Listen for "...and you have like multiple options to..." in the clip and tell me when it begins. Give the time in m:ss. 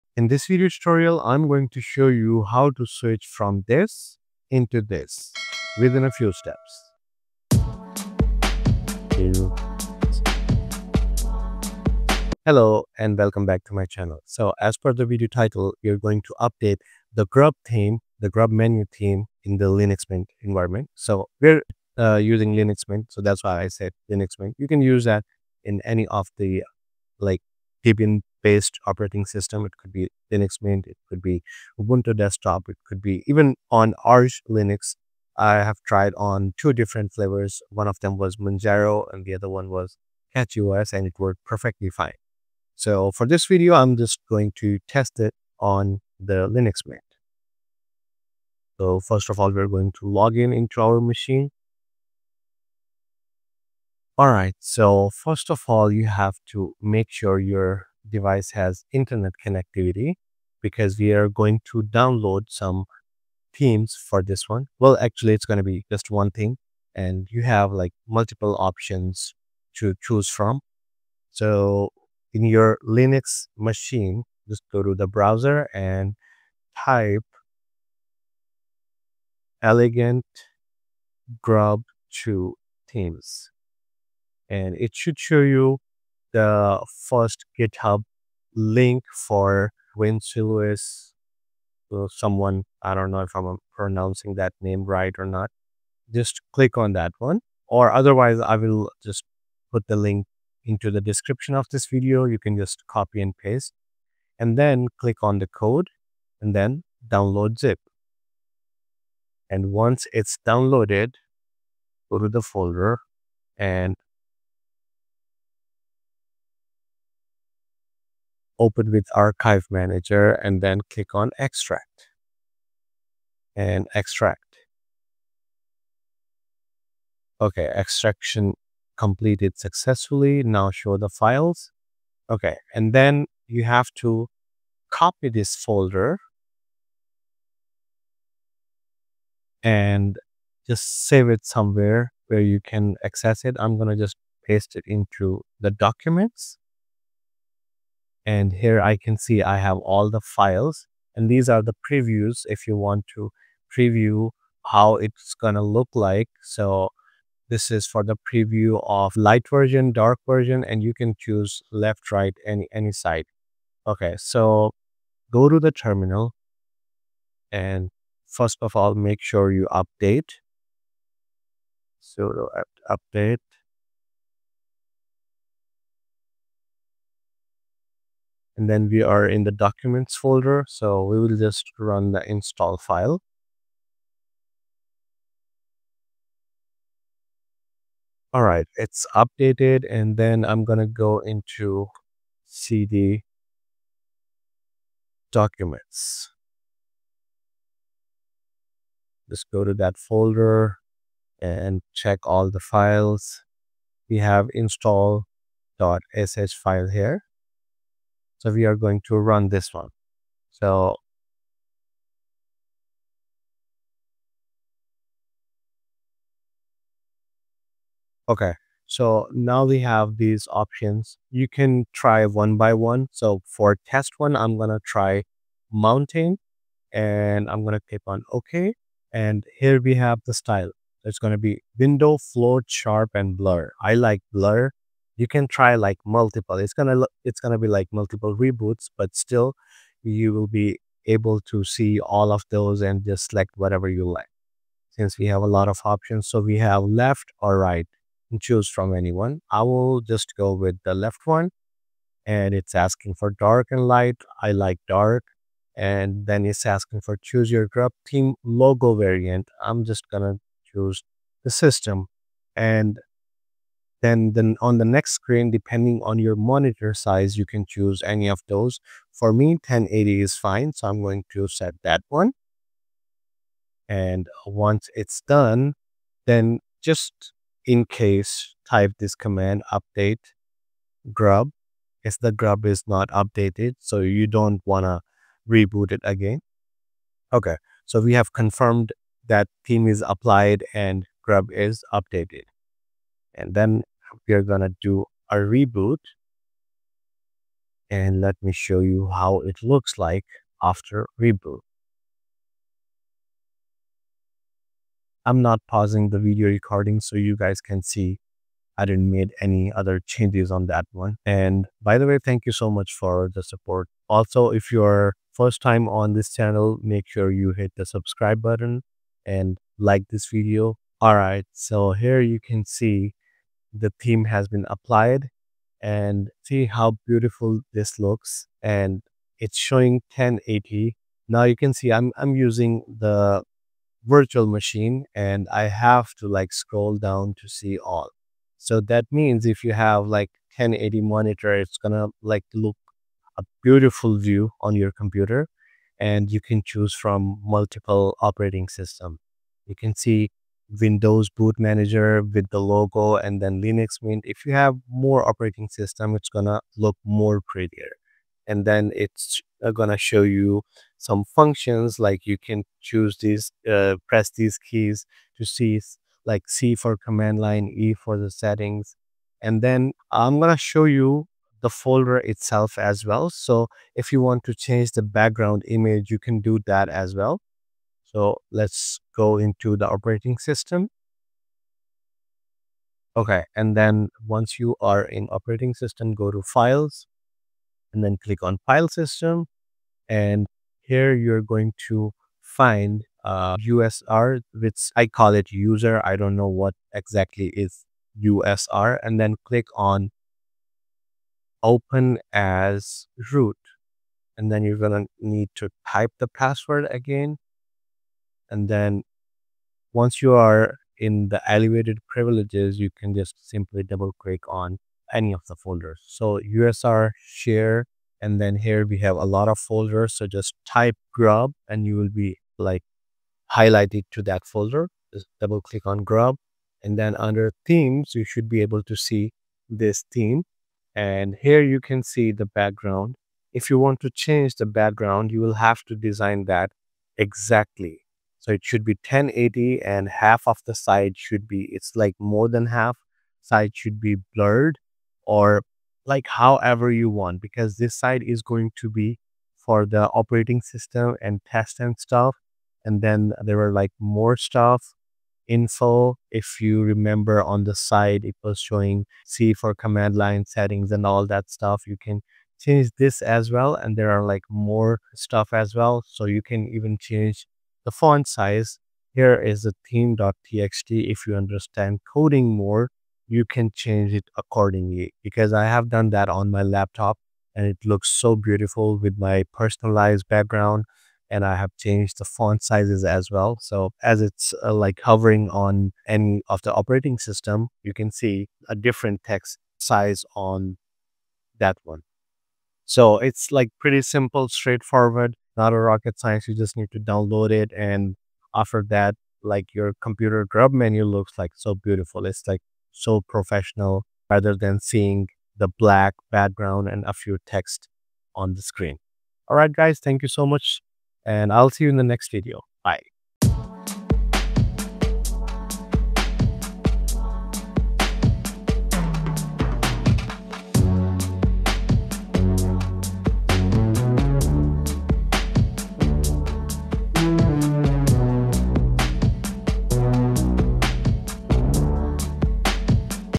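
1:06.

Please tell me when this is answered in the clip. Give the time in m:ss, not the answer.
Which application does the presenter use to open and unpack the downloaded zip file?
1:59.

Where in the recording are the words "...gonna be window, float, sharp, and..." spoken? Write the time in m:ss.
3:51.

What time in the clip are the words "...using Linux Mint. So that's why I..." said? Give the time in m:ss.
0:22.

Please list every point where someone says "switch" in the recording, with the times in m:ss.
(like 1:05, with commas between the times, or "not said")
0:02.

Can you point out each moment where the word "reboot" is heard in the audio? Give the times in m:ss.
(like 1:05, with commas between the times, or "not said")
3:58, 4:45, 4:55, 5:01.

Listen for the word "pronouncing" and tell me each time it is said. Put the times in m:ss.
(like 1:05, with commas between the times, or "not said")
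1:33.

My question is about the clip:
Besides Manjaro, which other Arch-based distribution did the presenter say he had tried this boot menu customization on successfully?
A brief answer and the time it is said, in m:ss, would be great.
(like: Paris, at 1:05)
CachyOS, at 0:40.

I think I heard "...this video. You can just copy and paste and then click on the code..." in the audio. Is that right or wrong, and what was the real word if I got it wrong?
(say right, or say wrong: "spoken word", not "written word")
right.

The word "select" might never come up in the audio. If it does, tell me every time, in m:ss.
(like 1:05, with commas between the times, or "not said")
4:03.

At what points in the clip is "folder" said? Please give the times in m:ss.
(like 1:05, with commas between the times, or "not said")
1:52, 2:15, 3:00, 3:19, 6:11, 6:55, 6:59, 7:04.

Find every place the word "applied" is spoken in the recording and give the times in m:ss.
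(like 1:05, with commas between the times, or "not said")
4:50, 5:24.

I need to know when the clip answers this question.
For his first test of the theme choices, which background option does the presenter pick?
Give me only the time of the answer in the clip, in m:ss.
3:45.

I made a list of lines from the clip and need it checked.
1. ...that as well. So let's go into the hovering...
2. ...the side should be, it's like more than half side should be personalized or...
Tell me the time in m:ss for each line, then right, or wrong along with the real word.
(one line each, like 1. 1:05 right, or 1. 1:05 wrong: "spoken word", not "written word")
1. 6:16 wrong: "operating", not "hovering"
2. 7:20 wrong: "blurred", not "personalized".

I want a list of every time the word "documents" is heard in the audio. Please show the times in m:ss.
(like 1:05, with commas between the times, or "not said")
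2:25, 2:59, 3:15.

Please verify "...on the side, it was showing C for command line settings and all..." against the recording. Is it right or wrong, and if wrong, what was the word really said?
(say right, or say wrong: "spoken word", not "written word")
right.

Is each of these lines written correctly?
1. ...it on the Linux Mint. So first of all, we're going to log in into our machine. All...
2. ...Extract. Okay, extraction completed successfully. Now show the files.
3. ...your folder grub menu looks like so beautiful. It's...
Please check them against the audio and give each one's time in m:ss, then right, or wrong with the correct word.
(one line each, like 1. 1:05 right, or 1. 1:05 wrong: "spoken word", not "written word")
1. 0:45 right
2. 2:03 right
3. 8:19 wrong: "computer", not "folder".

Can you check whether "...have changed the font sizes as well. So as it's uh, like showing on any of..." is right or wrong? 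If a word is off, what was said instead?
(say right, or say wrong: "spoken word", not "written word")
wrong: "hovering", not "showing".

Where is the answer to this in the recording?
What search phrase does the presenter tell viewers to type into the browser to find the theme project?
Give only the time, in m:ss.
1:19.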